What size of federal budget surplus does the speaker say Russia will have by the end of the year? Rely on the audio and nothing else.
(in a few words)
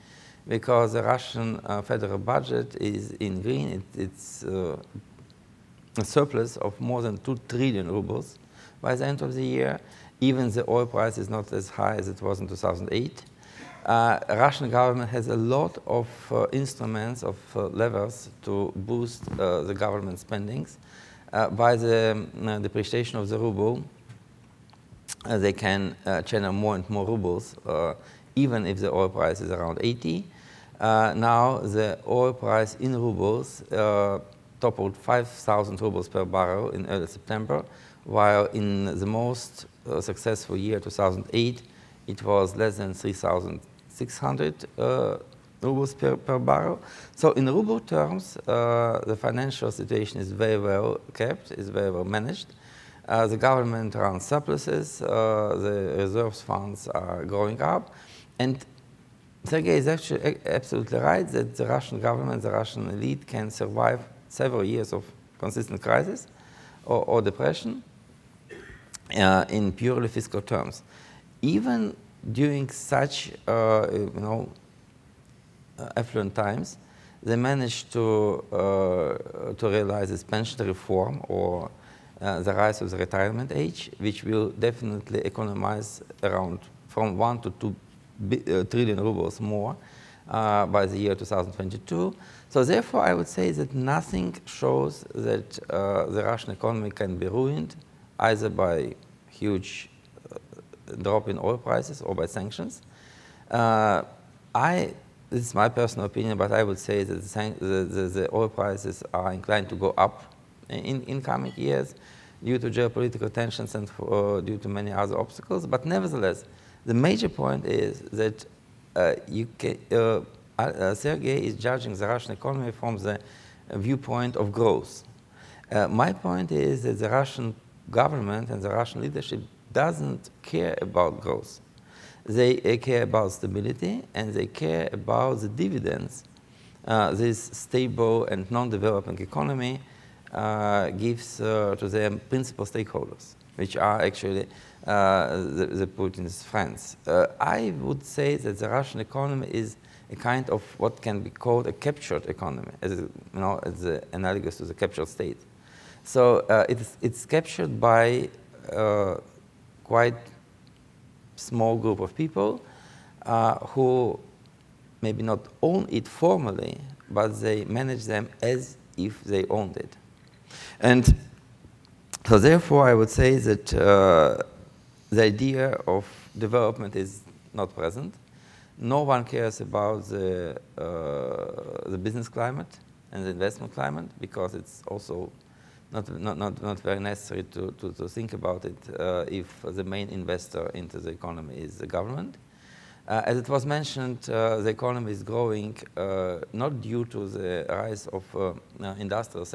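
more than 2 trillion rubles.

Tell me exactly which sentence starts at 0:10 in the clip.
Even the oil price is not as high as it was in 2008.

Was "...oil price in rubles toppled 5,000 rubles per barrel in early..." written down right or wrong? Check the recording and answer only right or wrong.
right.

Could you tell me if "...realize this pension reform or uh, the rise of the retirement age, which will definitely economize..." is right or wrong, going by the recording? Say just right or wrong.
right.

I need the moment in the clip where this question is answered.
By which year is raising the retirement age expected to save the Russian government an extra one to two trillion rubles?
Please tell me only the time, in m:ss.
1:31.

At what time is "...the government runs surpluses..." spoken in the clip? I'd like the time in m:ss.
0:53.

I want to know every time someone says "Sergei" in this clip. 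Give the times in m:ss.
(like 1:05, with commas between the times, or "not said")
0:59, 2:00.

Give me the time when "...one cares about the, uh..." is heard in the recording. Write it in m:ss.
2:59.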